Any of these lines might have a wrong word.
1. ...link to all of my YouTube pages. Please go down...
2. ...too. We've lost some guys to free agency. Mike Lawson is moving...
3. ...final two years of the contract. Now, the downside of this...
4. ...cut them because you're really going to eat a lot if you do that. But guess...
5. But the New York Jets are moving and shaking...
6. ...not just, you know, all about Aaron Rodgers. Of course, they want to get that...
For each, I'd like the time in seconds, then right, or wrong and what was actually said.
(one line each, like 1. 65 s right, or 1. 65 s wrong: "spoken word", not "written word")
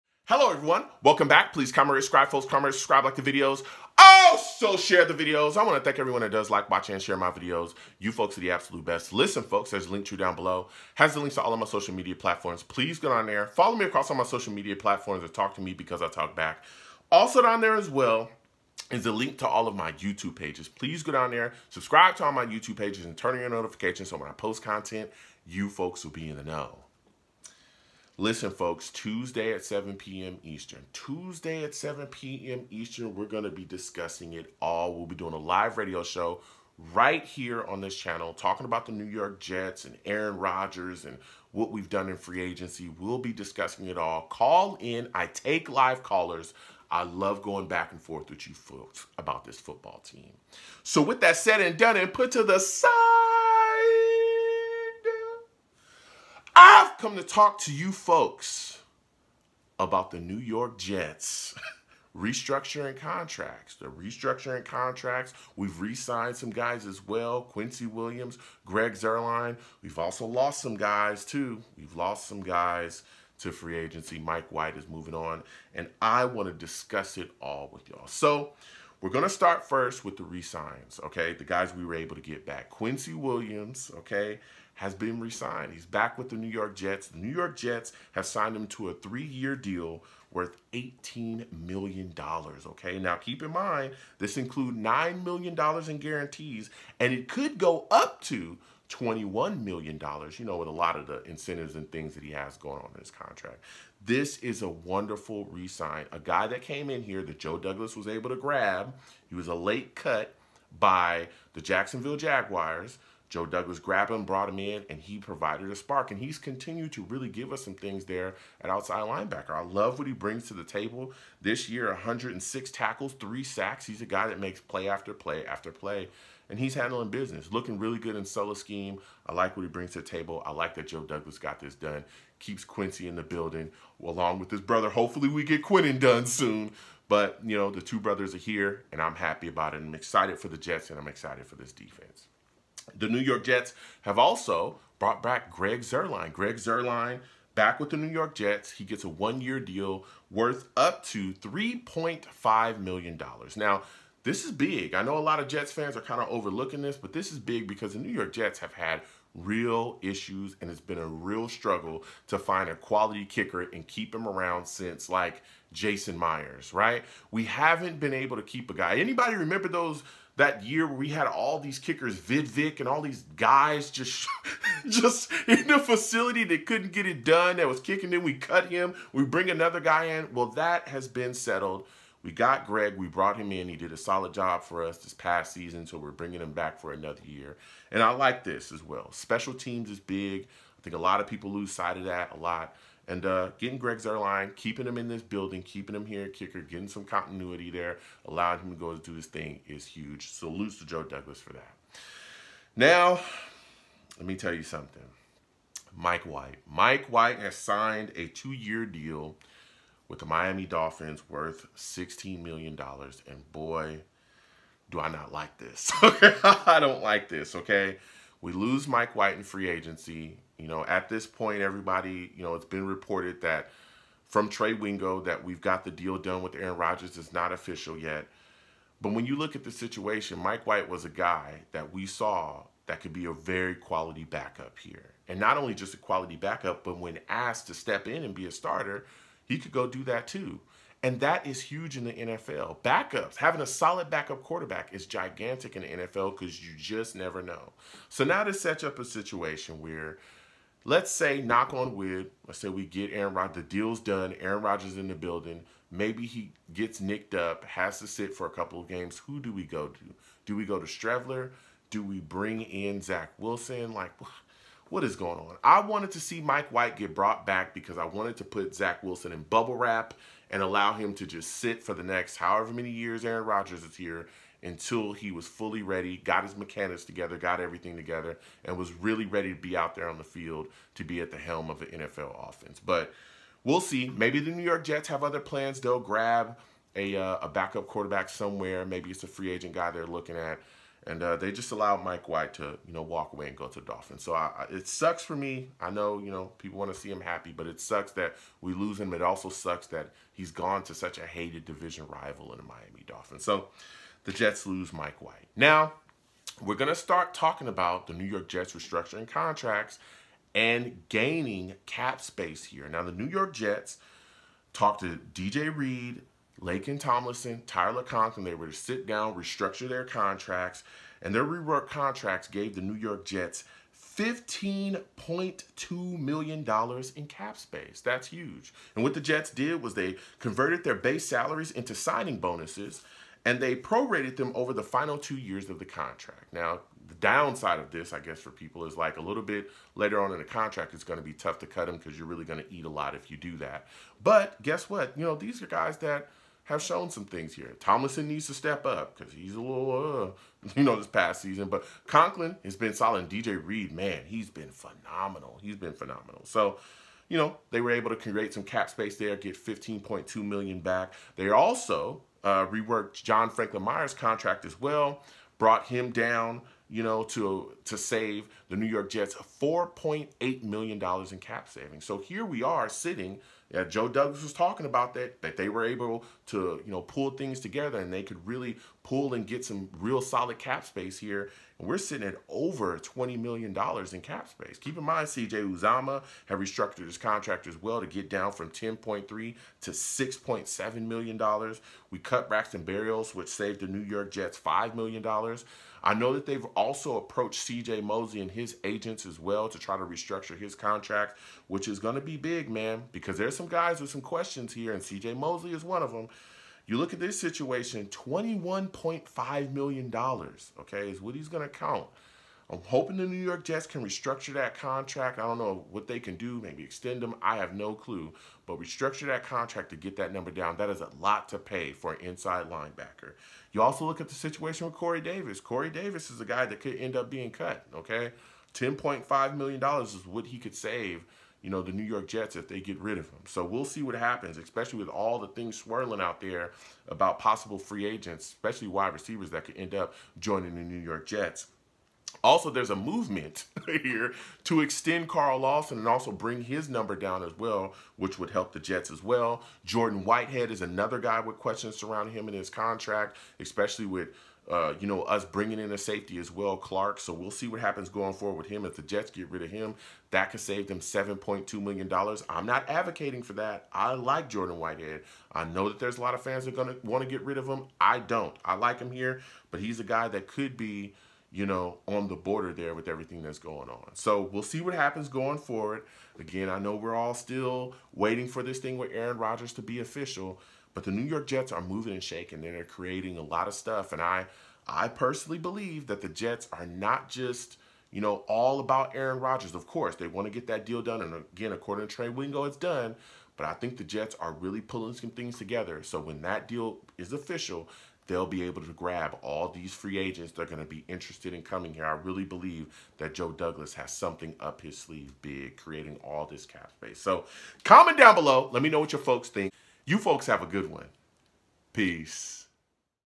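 1. 19 s right
2. 71 s wrong: "White", not "Lawson"
3. 334 s right
4. 341 s right
5. 480 s right
6. 486 s right.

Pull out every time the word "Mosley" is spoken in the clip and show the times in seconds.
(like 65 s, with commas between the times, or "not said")
398 s, 405 s.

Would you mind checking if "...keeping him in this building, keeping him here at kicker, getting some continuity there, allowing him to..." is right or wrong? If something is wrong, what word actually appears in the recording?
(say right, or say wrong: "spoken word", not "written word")
right.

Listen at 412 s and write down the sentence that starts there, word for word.
I'm hoping the New York Jets can restructure that contract.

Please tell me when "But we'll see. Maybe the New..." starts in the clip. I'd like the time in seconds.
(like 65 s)
282 s.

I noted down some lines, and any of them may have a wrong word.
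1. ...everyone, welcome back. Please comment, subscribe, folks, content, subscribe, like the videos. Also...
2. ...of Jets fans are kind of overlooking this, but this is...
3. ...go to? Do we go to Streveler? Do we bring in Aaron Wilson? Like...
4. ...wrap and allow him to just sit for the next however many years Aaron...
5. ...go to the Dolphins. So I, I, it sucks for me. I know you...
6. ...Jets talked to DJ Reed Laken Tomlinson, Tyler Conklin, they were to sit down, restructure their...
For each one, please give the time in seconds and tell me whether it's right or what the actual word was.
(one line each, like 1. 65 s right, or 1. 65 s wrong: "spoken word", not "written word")
1. 0 s wrong: "comment", not "content"
2. 155 s right
3. 259 s wrong: "Zach", not "Aaron"
4. 269 s right
5. 293 s right
6. 313 s right.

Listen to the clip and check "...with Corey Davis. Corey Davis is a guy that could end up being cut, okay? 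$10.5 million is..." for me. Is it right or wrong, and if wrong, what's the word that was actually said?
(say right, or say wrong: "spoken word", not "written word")
right.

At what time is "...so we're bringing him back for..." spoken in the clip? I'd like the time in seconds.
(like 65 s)
185 s.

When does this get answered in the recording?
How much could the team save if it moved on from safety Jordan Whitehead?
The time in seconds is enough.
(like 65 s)
461 s.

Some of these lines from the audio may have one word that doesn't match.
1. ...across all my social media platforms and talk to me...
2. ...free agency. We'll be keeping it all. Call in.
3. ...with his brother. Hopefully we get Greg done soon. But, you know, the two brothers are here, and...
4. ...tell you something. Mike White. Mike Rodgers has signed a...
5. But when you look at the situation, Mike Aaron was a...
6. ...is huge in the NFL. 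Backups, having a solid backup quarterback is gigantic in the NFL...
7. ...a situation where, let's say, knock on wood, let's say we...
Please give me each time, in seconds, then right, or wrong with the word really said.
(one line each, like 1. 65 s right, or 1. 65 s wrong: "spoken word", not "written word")
1. 13 s right
2. 42 s wrong: "discussing", not "keeping"
3. 134 s wrong: "Quinnen", not "Greg"
4. 204 s wrong: "White", not "Rodgers"
5. 228 s wrong: "White", not "Aaron"
6. 241 s right
7. 248 s right.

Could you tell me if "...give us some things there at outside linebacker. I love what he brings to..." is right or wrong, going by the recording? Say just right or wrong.
right.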